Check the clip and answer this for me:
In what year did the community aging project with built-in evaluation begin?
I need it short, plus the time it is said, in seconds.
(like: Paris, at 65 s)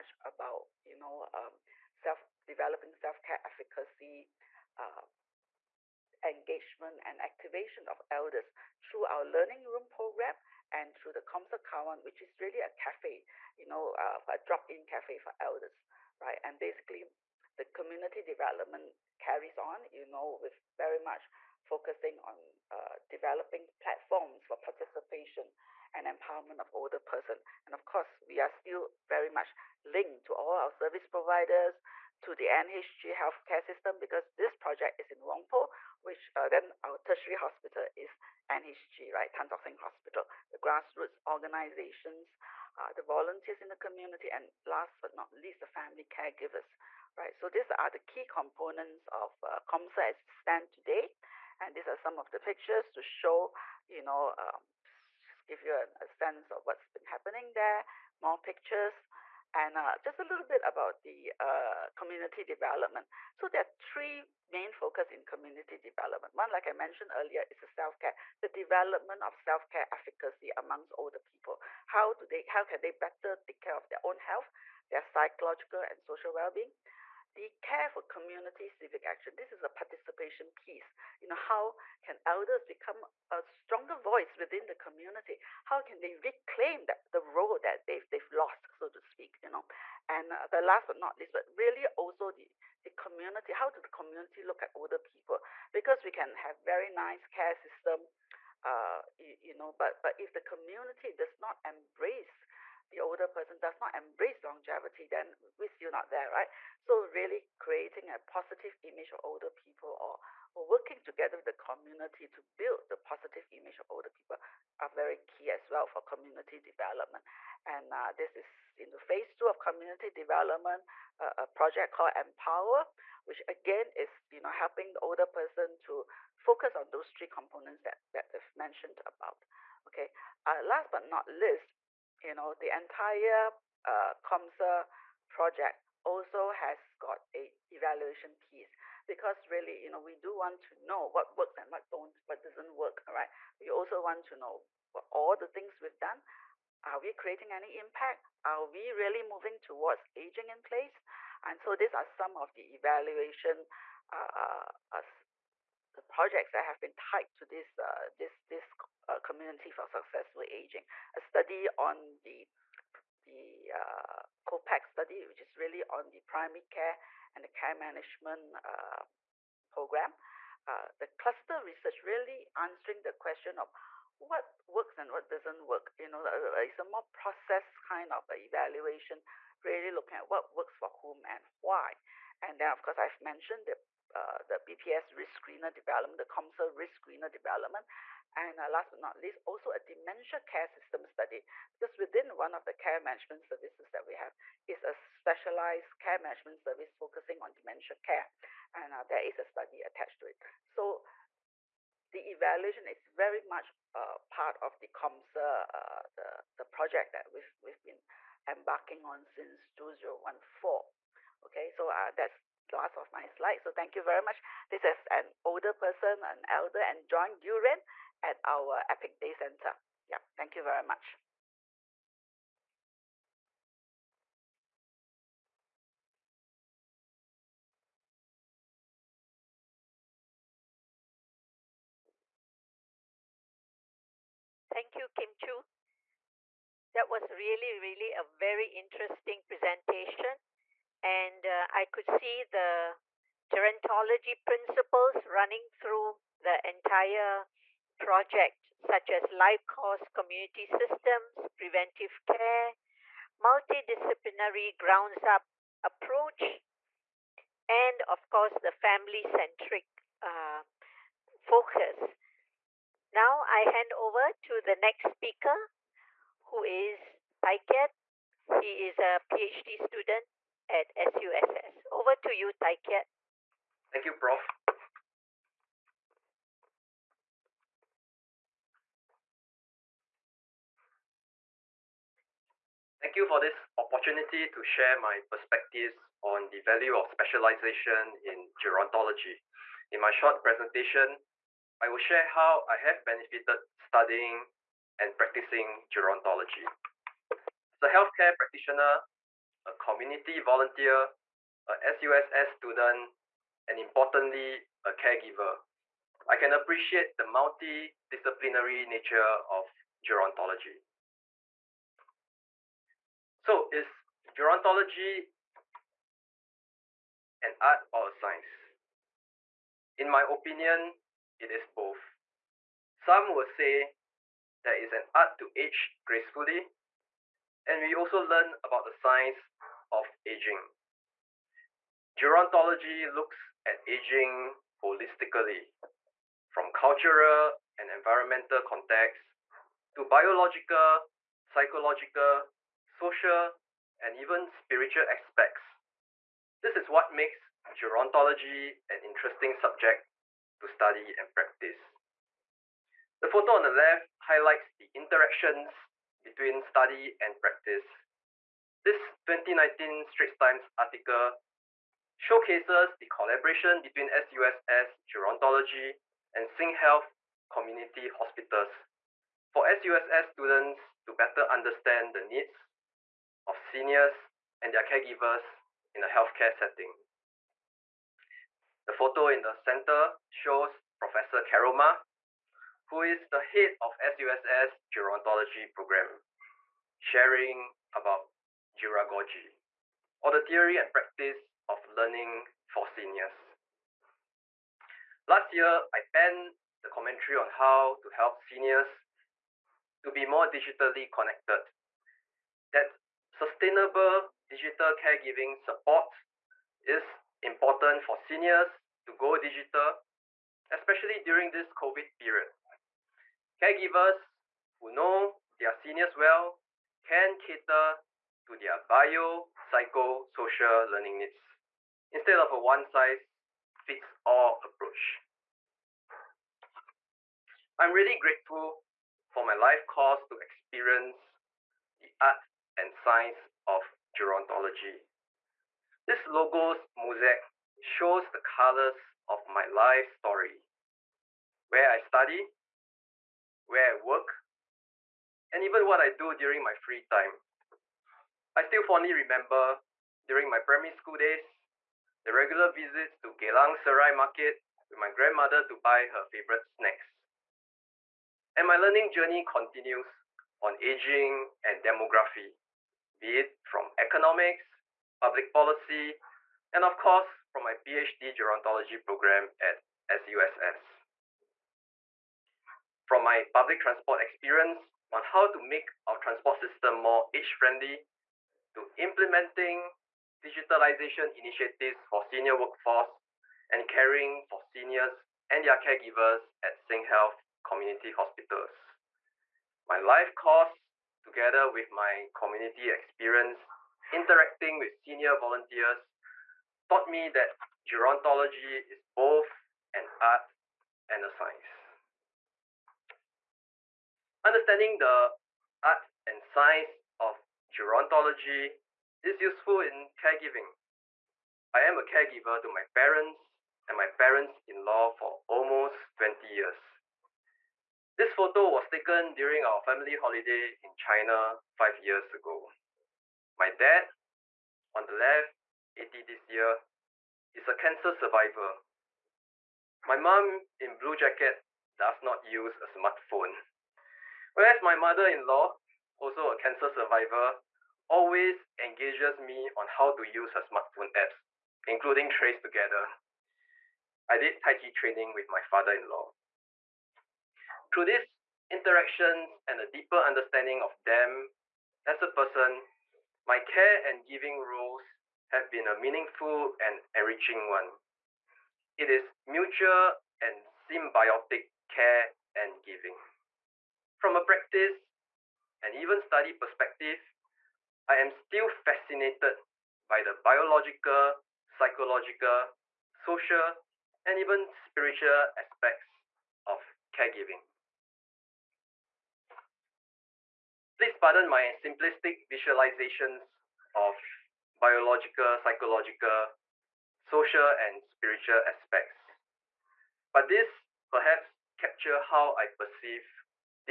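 2014, at 209 s.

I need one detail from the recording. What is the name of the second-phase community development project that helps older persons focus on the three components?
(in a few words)
Empower.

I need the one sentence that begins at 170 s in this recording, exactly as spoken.
Uh, the cluster research really answering the question of what works and what doesn't work.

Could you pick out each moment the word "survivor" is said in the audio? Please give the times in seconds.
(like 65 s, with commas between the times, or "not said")
528 s, 536 s.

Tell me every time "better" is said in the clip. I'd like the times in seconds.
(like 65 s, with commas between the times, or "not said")
72 s, 371 s.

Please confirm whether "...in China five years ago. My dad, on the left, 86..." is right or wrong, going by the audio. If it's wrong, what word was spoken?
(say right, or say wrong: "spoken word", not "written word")
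wrong: "80", not "86".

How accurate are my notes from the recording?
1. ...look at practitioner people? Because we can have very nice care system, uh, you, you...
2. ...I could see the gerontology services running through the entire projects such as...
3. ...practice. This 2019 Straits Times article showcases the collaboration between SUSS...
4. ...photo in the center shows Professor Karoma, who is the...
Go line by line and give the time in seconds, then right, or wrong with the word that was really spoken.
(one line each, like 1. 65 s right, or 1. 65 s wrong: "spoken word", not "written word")
1. 94 s wrong: "older", not "practitioner"
2. 241 s wrong: "principles", not "services"
3. 357 s right
4. 378 s right.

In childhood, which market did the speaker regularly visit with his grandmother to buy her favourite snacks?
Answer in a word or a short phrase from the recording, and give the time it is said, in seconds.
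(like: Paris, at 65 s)
Geylang Serai Market, at 453 s.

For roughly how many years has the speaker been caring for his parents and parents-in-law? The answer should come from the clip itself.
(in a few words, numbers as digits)
20 years.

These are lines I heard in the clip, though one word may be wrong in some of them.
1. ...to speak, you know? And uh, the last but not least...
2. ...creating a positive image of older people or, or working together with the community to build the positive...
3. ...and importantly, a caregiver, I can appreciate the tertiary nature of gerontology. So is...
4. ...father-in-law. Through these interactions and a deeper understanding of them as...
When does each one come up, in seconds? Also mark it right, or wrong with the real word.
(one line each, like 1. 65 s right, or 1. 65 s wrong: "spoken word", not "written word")
1. 88 s right
2. 107 s right
3. 303 s wrong: "multidisciplinary", not "tertiary"
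4. 545 s right.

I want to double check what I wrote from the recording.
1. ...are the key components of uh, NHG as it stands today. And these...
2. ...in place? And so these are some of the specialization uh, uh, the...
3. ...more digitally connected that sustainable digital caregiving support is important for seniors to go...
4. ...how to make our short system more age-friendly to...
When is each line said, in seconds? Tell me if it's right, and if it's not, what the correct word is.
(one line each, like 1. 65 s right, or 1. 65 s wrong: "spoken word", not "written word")
1. 47 s wrong: "COMSA", not "NHG"
2. 150 s wrong: "evaluation", not "specialization"
3. 400 s right
4. 475 s wrong: "transport", not "short".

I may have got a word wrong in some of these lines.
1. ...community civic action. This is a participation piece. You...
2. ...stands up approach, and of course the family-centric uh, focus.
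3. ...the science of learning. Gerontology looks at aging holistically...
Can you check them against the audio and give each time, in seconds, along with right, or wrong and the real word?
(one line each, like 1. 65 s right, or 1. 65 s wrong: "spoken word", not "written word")
1. 78 s right
2. 254 s wrong: "grounds", not "stands"
3. 328 s wrong: "aging", not "learning".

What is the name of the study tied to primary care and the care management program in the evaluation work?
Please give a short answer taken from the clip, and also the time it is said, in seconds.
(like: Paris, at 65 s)
COPAC study, at 164 s.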